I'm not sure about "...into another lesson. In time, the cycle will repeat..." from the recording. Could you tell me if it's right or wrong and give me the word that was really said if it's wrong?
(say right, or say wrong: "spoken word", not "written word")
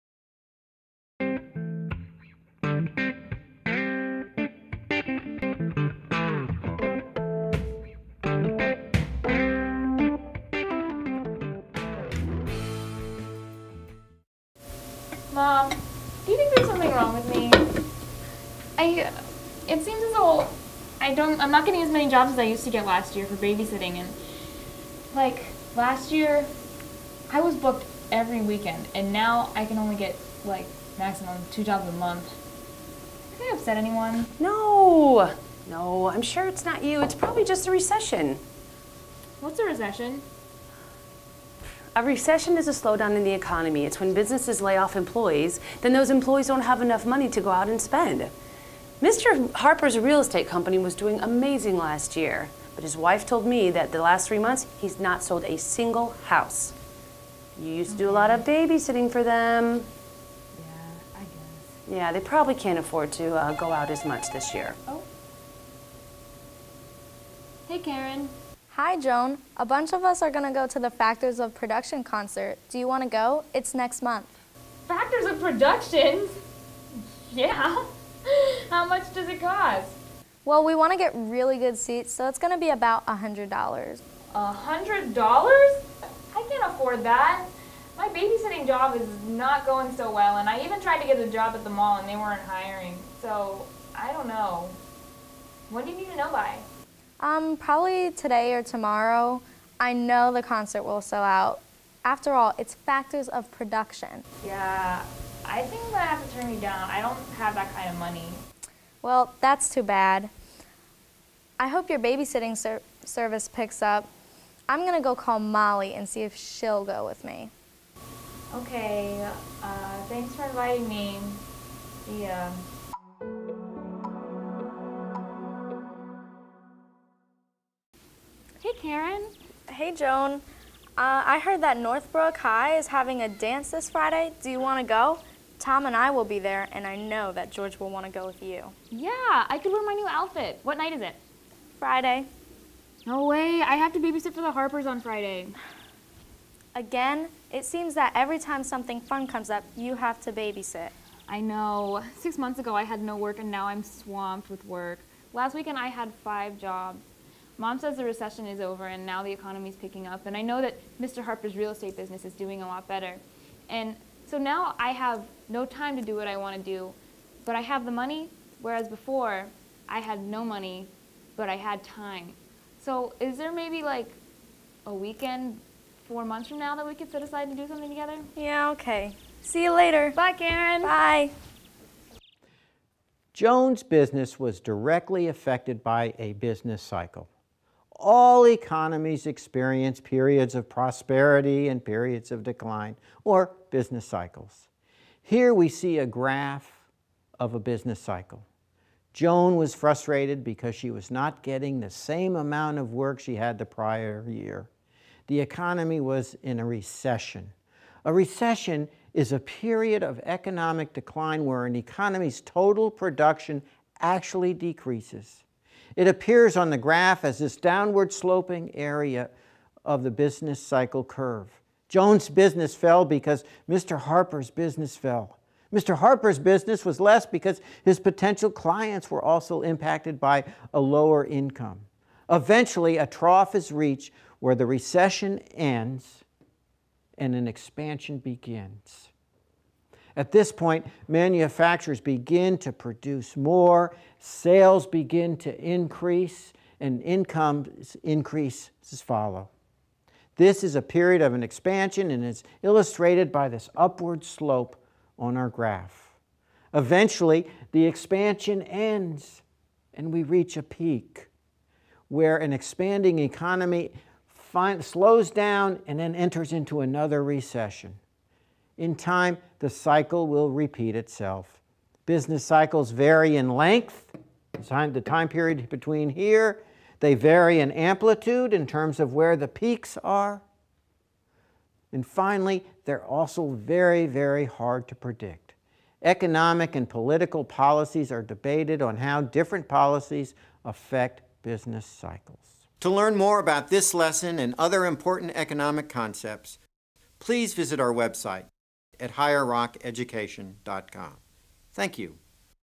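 wrong: "recession", not "lesson".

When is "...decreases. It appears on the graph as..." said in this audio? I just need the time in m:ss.
3:34.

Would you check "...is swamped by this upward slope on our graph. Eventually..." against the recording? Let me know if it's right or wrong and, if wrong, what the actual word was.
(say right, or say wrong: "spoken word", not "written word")
wrong: "illustrated", not "swamped".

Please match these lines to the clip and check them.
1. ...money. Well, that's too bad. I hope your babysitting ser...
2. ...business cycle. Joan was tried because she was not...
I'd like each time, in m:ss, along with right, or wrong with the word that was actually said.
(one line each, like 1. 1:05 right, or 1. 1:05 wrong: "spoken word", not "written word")
1. 1:47 right
2. 3:17 wrong: "frustrated", not "tried".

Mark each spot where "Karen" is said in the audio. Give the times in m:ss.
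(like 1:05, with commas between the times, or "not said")
1:07, 2:08, 3:00.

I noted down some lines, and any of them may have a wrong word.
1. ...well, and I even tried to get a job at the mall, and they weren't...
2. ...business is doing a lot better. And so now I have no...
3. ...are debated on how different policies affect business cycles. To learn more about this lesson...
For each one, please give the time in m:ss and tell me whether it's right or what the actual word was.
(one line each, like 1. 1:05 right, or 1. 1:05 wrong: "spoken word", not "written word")
1. 1:30 right
2. 2:41 right
3. 4:48 right.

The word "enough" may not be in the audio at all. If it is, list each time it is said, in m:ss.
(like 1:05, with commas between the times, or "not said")
0:46.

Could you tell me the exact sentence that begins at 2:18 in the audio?
Yeah, I could wear my new outfit.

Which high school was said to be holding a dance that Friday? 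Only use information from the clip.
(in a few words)
Northbrook High.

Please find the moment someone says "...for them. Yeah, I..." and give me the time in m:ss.
0:59.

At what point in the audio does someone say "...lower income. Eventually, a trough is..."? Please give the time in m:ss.
3:50.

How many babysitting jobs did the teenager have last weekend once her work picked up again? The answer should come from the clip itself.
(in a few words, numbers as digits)
5.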